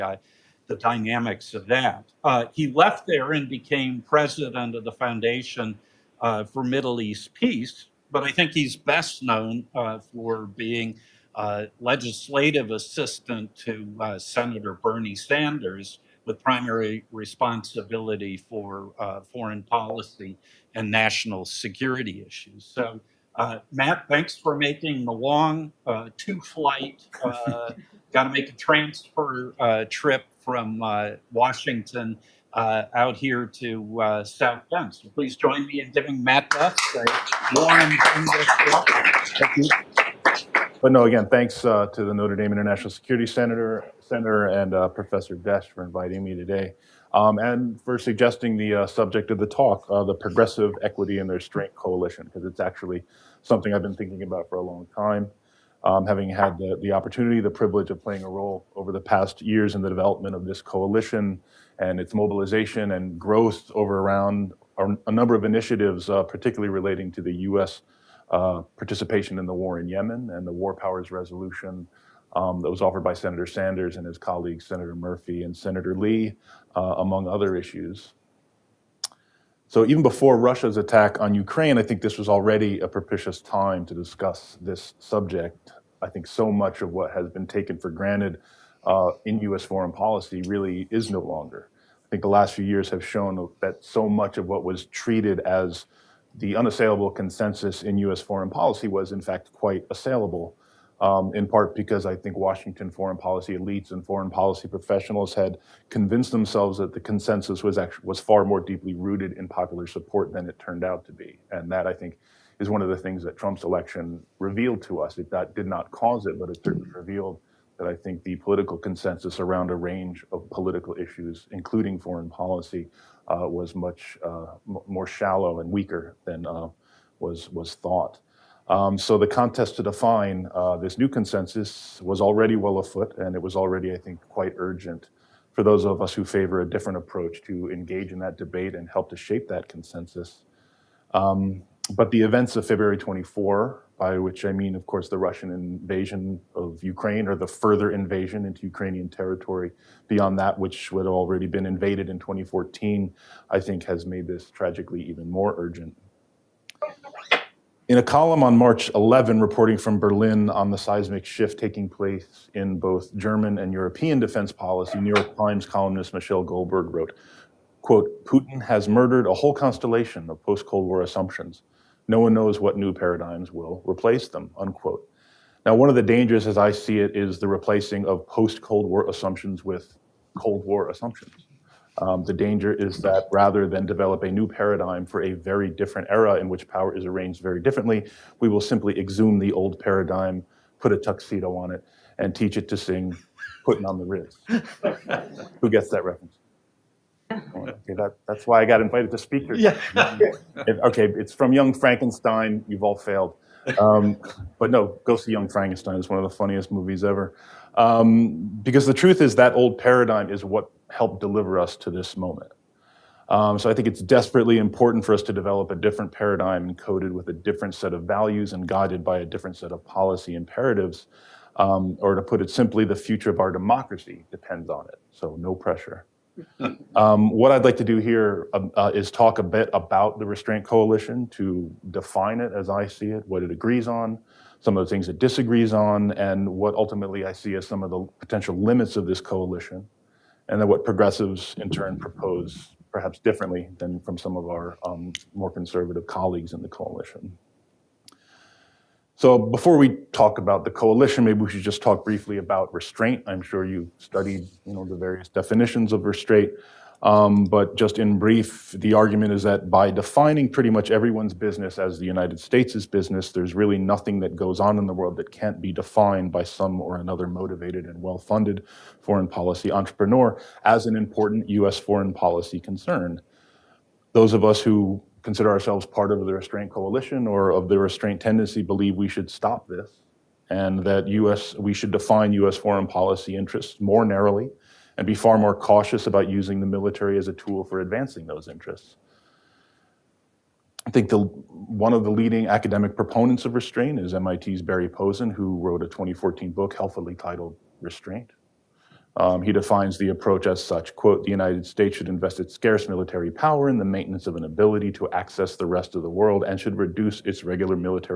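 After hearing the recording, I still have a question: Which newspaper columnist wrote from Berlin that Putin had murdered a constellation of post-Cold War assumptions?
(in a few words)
Michelle Goldberg.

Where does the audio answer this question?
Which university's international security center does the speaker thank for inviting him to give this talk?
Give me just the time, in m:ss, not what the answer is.
0:42.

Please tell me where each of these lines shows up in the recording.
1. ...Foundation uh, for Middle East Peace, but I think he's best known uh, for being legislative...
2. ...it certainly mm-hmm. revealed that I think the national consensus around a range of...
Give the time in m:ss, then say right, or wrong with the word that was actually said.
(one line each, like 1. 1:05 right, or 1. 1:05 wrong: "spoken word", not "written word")
1. 0:04 right
2. 1:56 wrong: "political", not "national".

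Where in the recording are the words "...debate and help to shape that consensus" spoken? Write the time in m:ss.
2:18.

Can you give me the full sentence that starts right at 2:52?
No one knows what new paradigms will replace them, unquote.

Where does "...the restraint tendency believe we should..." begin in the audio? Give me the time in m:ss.
4:37.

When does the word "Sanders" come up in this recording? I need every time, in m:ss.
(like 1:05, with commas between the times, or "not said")
0:15, 1:13.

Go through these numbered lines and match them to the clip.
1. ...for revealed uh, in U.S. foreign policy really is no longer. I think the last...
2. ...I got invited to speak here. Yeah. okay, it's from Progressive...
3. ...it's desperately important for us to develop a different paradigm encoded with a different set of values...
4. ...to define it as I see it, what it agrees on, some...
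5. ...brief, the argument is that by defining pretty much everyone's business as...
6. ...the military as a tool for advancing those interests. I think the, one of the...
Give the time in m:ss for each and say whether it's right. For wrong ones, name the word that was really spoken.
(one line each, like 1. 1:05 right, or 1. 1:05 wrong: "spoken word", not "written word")
1. 1:27 wrong: "granted", not "revealed"
2. 3:18 wrong: "Young", not "Progressive"
3. 3:33 right
4. 3:51 right
5. 4:18 right
6. 4:46 right.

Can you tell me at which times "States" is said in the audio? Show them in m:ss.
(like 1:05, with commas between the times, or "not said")
4:22, 5:01.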